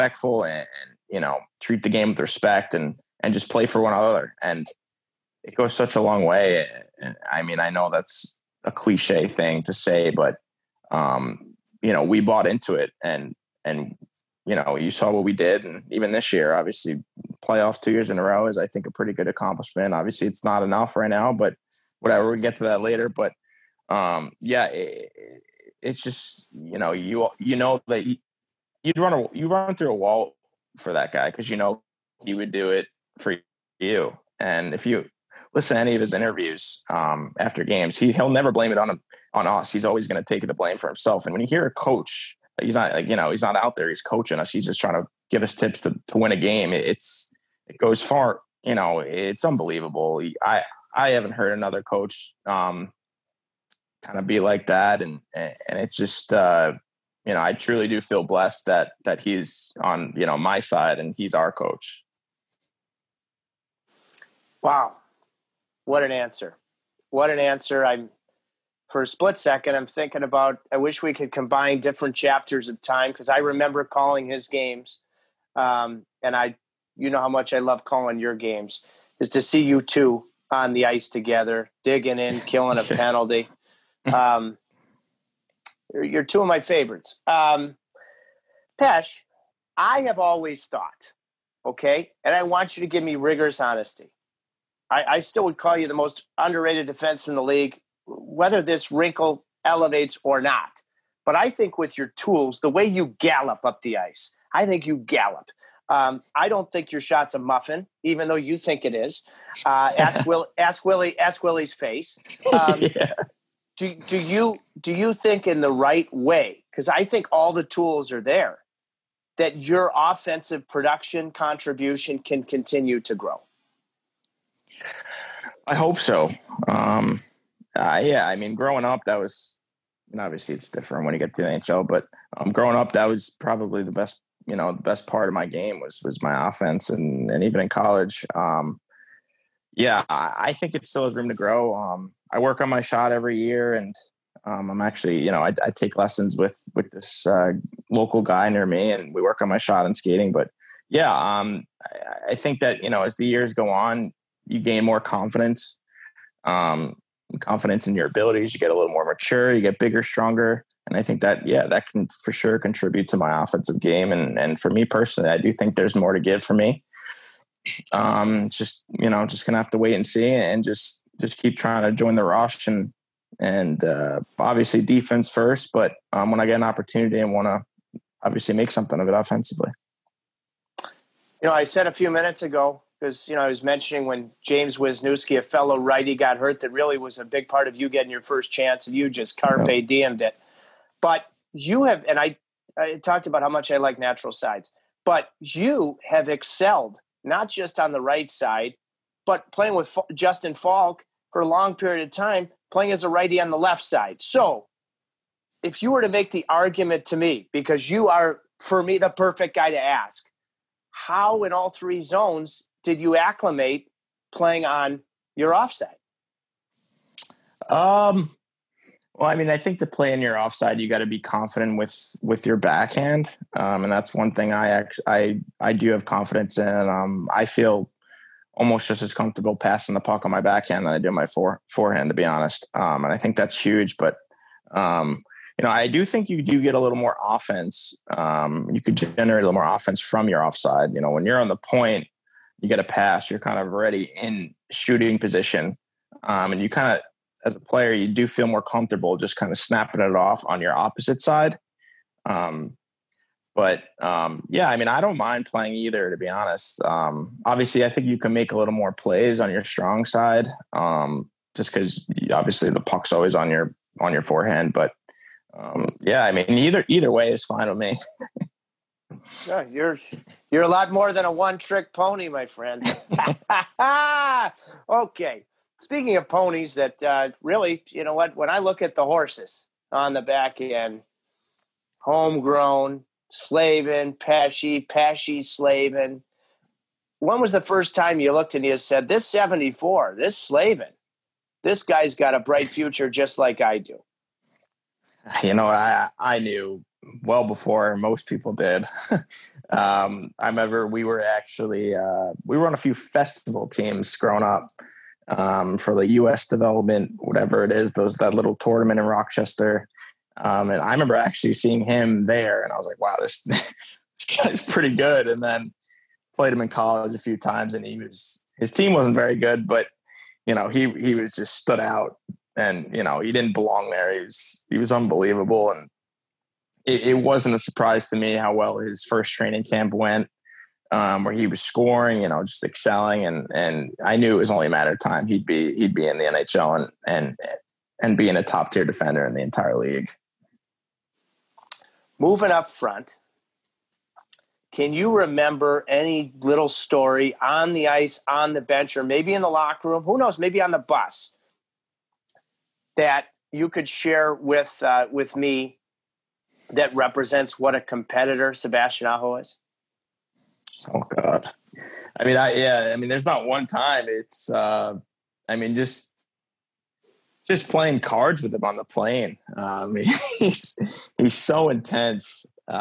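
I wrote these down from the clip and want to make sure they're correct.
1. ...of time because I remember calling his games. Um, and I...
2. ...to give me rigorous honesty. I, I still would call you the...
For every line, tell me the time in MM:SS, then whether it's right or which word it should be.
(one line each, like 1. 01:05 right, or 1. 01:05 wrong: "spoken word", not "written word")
1. 01:12 right
2. 01:32 right.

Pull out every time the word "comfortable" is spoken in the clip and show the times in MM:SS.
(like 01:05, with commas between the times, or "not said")
03:49, 04:08.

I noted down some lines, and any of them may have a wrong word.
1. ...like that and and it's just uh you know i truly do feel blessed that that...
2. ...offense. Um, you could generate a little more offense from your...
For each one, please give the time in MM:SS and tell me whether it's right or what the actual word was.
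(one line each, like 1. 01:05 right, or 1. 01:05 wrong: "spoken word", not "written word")
1. 00:54 right
2. 03:57 right.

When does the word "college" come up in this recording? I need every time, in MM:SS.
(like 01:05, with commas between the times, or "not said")
02:17, 05:16.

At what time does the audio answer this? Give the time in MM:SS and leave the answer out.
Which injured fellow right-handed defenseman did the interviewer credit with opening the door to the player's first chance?
03:04.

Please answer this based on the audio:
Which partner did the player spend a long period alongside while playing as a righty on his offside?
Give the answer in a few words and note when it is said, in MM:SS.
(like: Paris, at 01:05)
Justin Faulk, at 03:20.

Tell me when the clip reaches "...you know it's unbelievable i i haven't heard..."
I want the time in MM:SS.
00:48.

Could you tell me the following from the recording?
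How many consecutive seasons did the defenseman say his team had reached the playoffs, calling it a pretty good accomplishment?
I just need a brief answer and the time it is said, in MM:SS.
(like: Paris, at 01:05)
2, at 00:17.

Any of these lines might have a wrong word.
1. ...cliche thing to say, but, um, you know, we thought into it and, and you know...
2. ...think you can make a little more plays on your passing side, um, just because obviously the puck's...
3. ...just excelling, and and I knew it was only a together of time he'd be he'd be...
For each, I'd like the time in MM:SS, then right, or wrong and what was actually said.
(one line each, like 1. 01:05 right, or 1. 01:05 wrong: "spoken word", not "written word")
1. 00:08 wrong: "bought", not "thought"
2. 04:17 wrong: "strong", not "passing"
3. 05:32 wrong: "matter", not "together".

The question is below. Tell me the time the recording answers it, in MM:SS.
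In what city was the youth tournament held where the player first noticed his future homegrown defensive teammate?
05:09.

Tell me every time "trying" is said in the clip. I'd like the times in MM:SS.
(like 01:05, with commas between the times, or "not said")
00:44, 02:51.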